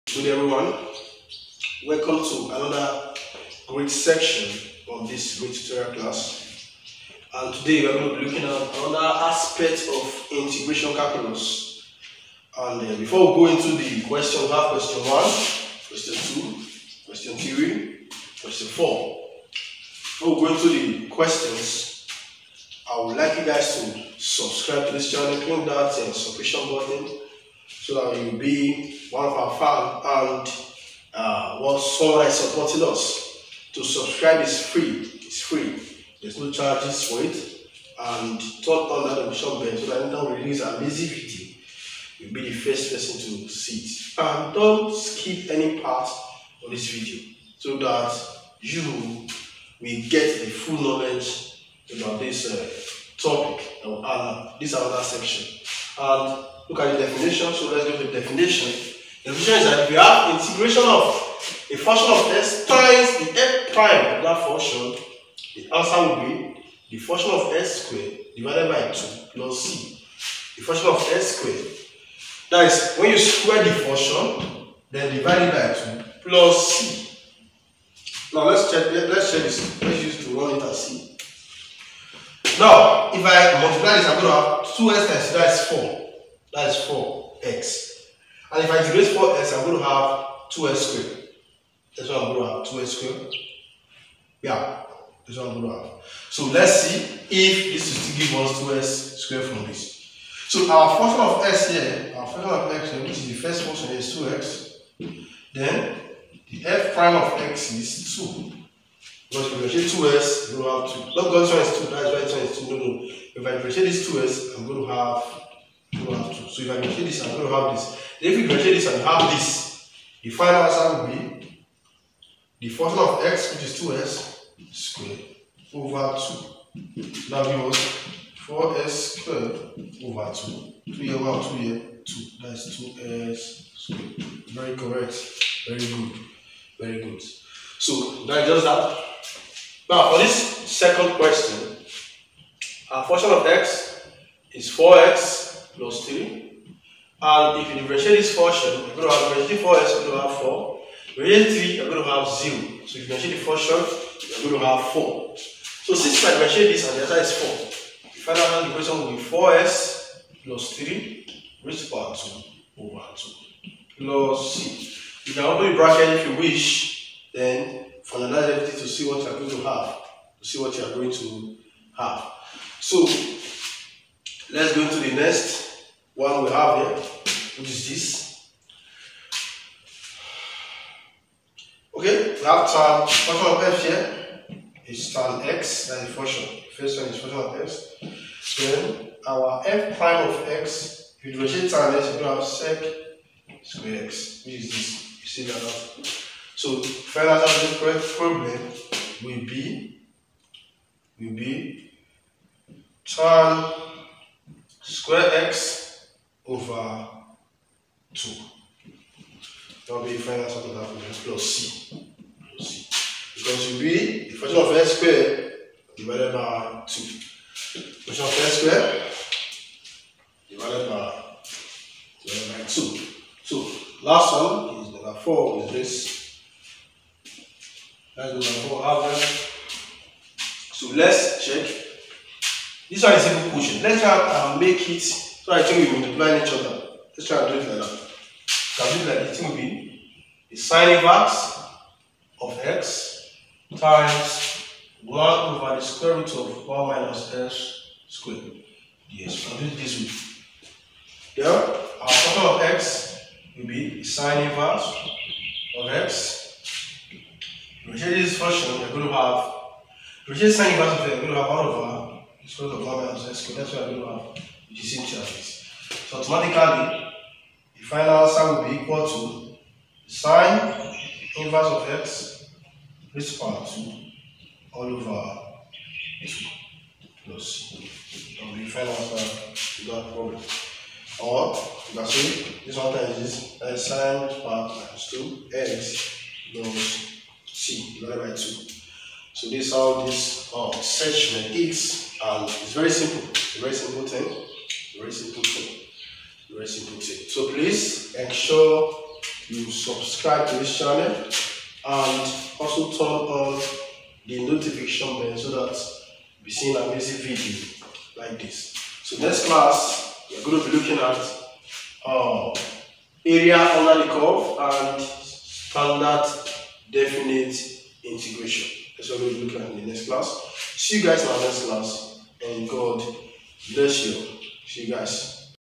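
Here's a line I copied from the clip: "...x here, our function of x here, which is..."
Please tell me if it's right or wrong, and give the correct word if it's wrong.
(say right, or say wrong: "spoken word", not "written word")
right.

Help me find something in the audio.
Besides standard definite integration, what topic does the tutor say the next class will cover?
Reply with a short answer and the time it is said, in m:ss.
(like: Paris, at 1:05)
area under the curve, at 5:13.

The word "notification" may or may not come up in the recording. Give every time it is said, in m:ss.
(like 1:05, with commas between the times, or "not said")
0:39, 5:04.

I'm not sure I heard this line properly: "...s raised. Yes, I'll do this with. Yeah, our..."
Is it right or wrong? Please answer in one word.
wrong.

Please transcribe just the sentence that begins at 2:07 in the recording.
That gives us 4s squared over 2.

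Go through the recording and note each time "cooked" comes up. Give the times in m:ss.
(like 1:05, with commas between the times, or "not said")
not said.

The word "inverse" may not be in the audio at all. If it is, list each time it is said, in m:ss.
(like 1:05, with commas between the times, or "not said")
4:14, 4:20, 4:31.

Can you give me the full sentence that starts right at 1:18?
Now let's check let, let's check this.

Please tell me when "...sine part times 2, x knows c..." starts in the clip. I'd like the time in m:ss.
4:43.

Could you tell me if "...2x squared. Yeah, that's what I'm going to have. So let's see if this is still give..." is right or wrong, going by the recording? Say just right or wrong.
right.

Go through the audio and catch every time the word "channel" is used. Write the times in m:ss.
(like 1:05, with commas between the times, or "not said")
0:25, 5:00.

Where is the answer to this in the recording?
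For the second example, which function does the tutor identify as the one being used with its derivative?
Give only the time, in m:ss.
2:24.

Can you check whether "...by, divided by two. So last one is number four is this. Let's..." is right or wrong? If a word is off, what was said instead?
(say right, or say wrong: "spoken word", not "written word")
right.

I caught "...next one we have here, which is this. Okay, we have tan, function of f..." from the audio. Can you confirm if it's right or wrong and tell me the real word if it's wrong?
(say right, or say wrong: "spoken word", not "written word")
right.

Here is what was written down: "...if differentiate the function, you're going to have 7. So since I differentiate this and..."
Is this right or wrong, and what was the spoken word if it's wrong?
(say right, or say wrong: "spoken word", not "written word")
wrong: "4", not "7".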